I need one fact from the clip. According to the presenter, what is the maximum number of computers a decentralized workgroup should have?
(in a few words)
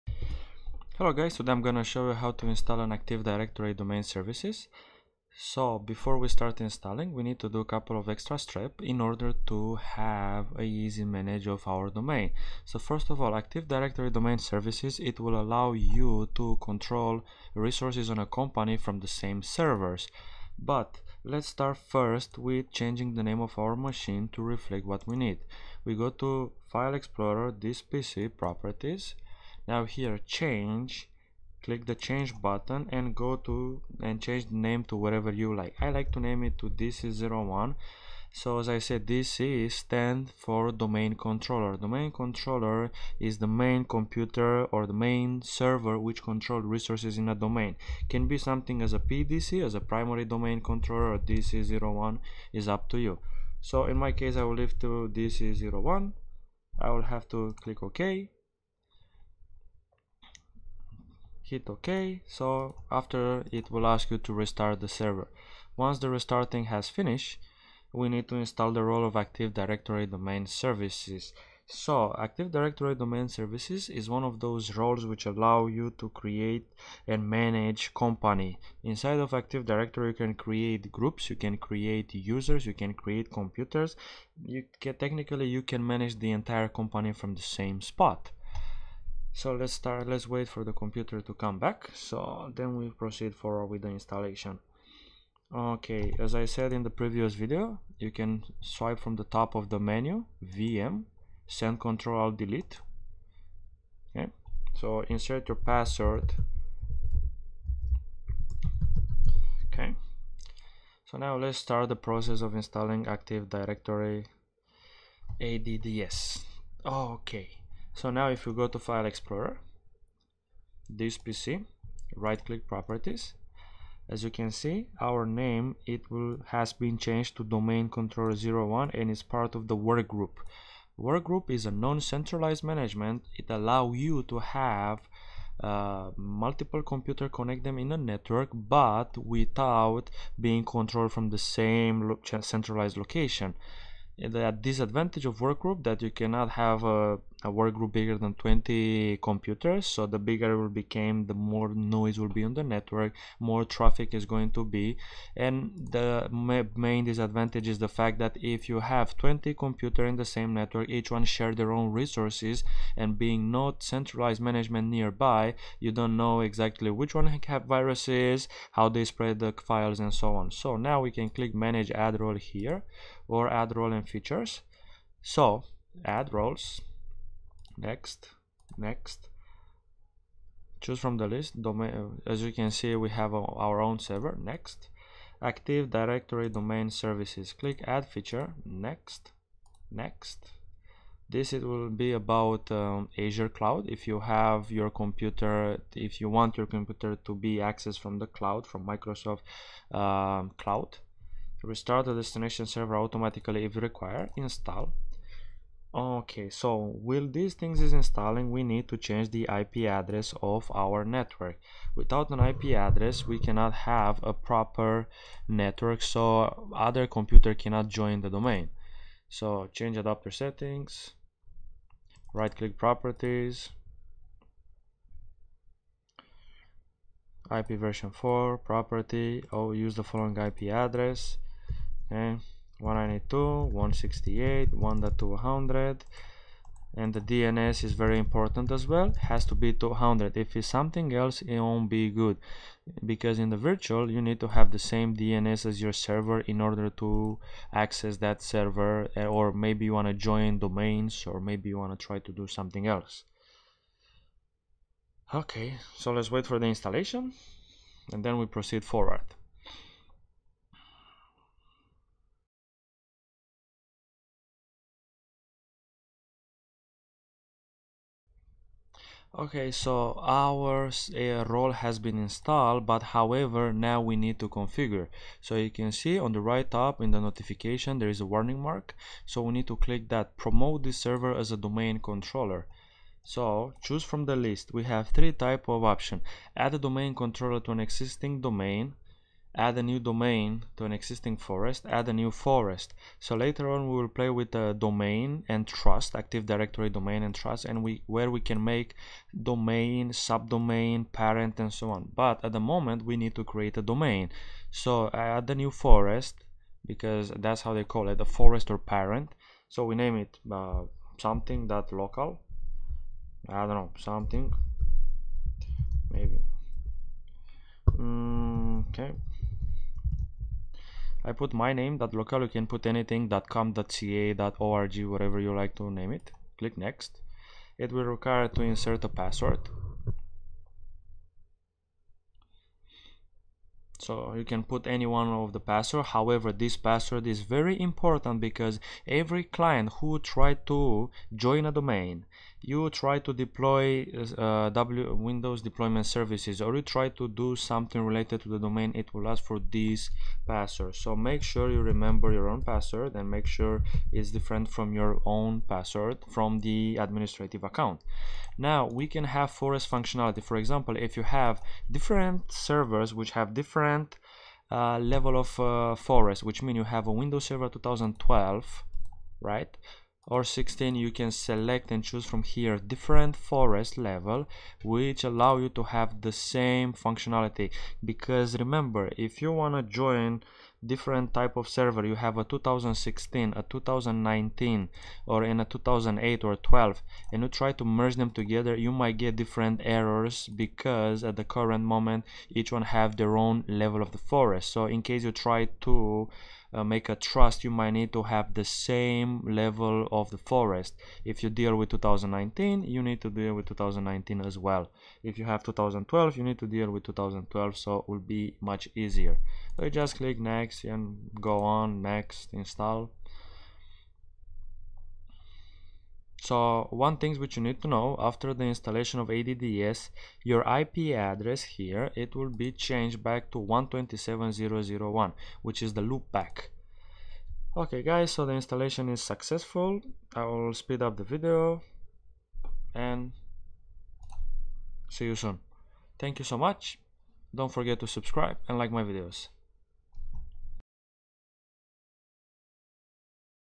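20.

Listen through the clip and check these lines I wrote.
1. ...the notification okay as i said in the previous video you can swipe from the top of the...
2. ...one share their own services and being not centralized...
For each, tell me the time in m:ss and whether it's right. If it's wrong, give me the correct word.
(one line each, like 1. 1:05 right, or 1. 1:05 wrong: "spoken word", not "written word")
1. 1:33 wrong: "installation", not "notification"
2. 2:41 wrong: "resources", not "services".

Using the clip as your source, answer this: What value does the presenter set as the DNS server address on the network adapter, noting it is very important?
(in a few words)
200.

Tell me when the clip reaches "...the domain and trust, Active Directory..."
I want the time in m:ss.
4:54.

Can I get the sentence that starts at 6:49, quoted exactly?
So you just click next and go on, next, install.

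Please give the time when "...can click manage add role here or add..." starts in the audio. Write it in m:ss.
2:51.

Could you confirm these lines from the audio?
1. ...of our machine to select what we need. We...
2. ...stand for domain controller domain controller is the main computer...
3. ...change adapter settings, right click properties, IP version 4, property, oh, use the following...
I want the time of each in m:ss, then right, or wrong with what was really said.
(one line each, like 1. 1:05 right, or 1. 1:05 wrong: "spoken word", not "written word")
1. 0:23 wrong: "reflect", not "select"
2. 0:39 right
3. 3:39 right.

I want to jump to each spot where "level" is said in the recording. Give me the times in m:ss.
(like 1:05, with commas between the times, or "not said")
6:04, 6:13, 6:33, 6:39.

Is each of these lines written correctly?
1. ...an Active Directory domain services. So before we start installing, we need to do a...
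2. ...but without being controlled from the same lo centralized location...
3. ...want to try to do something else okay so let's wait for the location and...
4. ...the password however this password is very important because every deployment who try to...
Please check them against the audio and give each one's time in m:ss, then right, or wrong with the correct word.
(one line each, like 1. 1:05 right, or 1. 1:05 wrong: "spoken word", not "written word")
1. 0:02 right
2. 2:18 right
3. 4:11 wrong: "installation", not "location"
4. 5:35 wrong: "client", not "deployment".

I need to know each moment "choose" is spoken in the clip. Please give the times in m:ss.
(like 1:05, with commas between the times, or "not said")
3:00, 4:43, 6:12.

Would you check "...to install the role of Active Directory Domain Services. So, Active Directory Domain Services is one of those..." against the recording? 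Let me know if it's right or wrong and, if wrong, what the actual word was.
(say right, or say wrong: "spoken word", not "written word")
right.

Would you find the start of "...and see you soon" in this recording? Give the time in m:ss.
7:12.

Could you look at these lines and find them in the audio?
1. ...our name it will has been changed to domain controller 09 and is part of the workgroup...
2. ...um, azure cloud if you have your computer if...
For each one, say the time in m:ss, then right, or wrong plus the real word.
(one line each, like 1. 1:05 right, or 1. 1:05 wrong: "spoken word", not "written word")
1. 2:05 wrong: "01", not "09"
2. 3:12 right.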